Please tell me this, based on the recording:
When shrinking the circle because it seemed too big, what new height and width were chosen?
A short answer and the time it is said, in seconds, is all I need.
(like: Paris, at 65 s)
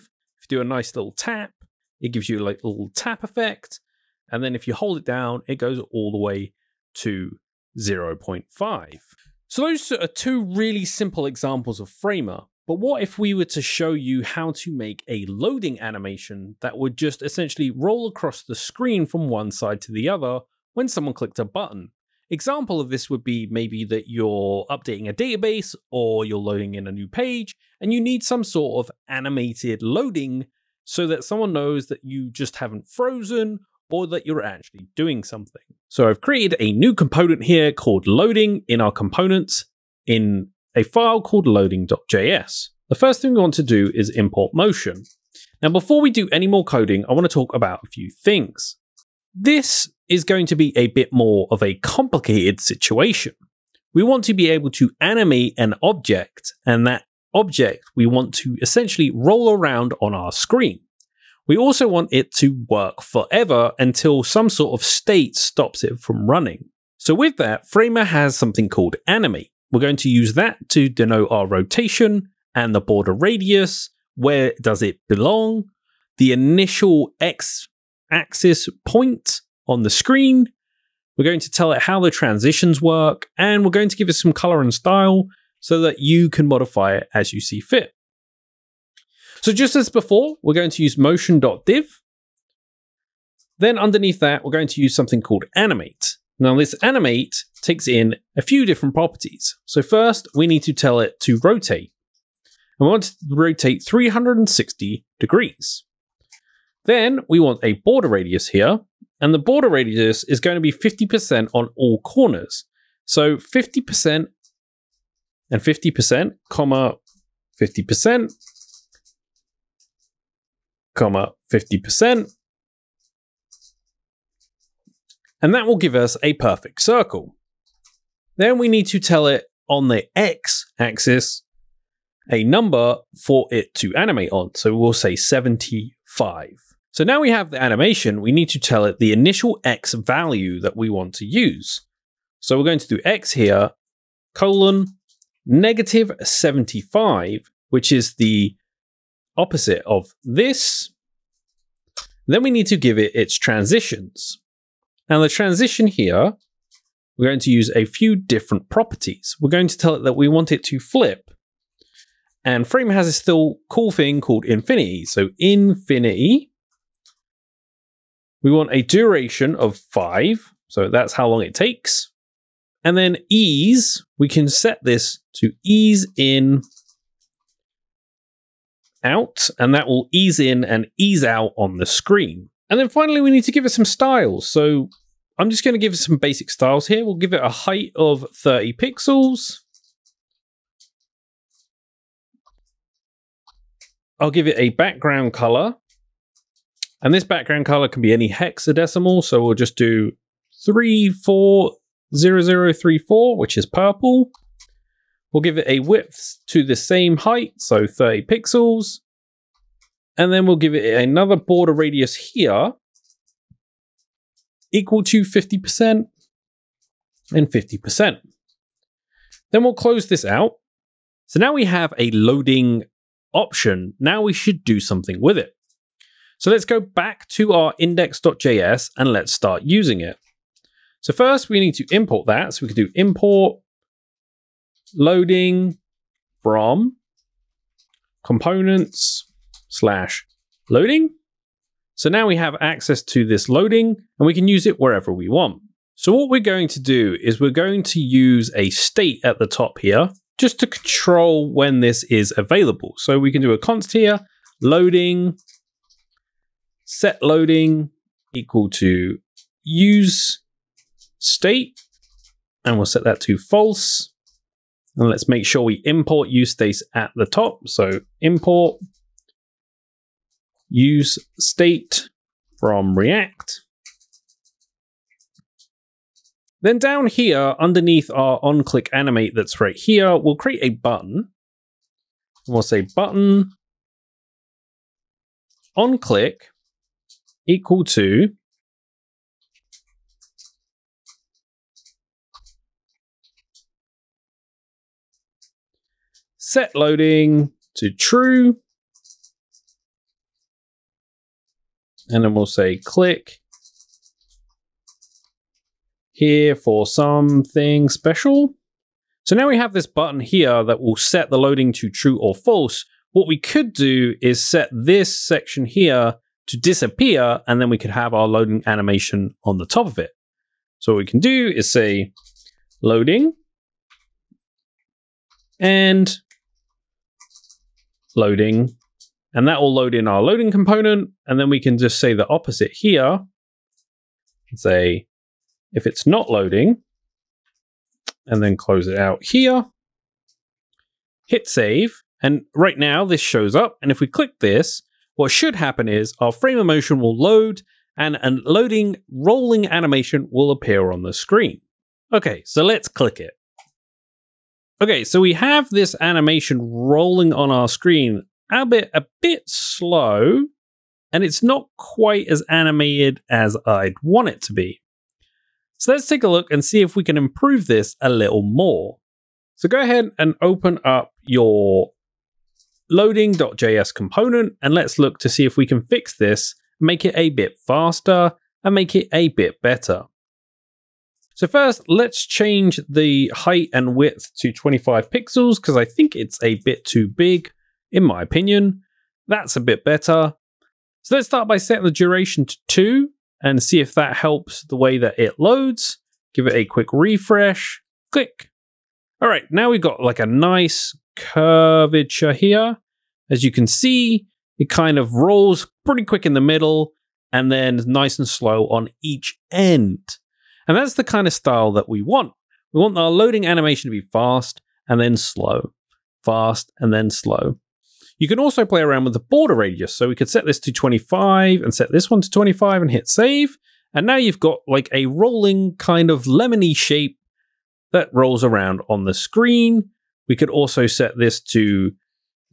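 25 pixels, at 384 s.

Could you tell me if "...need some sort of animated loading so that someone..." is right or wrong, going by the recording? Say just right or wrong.
right.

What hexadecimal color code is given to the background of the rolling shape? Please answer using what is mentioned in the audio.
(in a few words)
340034.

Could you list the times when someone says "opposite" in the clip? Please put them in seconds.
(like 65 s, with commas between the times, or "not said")
149 s, 332 s.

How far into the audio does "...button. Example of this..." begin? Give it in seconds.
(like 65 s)
21 s.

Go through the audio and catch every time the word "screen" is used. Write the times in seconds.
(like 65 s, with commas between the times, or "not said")
18 s, 60 s, 79 s, 181 s, 351 s, 357 s, 429 s.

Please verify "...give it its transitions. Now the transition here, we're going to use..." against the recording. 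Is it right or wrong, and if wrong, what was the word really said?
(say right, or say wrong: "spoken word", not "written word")
right.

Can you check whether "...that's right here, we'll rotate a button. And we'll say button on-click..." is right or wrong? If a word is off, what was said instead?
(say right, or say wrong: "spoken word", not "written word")
wrong: "create", not "rotate".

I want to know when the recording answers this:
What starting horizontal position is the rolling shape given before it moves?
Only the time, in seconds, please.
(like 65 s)
145 s.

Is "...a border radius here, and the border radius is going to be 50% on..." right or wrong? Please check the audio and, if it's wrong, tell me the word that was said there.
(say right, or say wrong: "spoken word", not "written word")
right.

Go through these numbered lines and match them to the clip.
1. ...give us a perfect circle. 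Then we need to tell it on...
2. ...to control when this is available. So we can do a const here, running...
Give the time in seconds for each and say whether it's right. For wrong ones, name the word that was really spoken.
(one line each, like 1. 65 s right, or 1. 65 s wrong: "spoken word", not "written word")
1. 125 s right
2. 250 s wrong: "loading", not "running".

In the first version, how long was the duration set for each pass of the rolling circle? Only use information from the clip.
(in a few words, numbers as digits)
5.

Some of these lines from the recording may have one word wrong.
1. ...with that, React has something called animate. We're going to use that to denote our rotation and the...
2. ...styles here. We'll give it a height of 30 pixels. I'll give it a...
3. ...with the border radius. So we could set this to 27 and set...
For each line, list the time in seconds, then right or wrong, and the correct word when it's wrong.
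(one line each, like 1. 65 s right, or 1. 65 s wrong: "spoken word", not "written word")
1. 67 s wrong: "Framer", not "React"
2. 186 s right
3. 419 s wrong: "25", not "27".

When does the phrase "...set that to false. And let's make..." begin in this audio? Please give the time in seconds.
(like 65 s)
262 s.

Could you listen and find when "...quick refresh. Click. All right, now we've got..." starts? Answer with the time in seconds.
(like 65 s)
396 s.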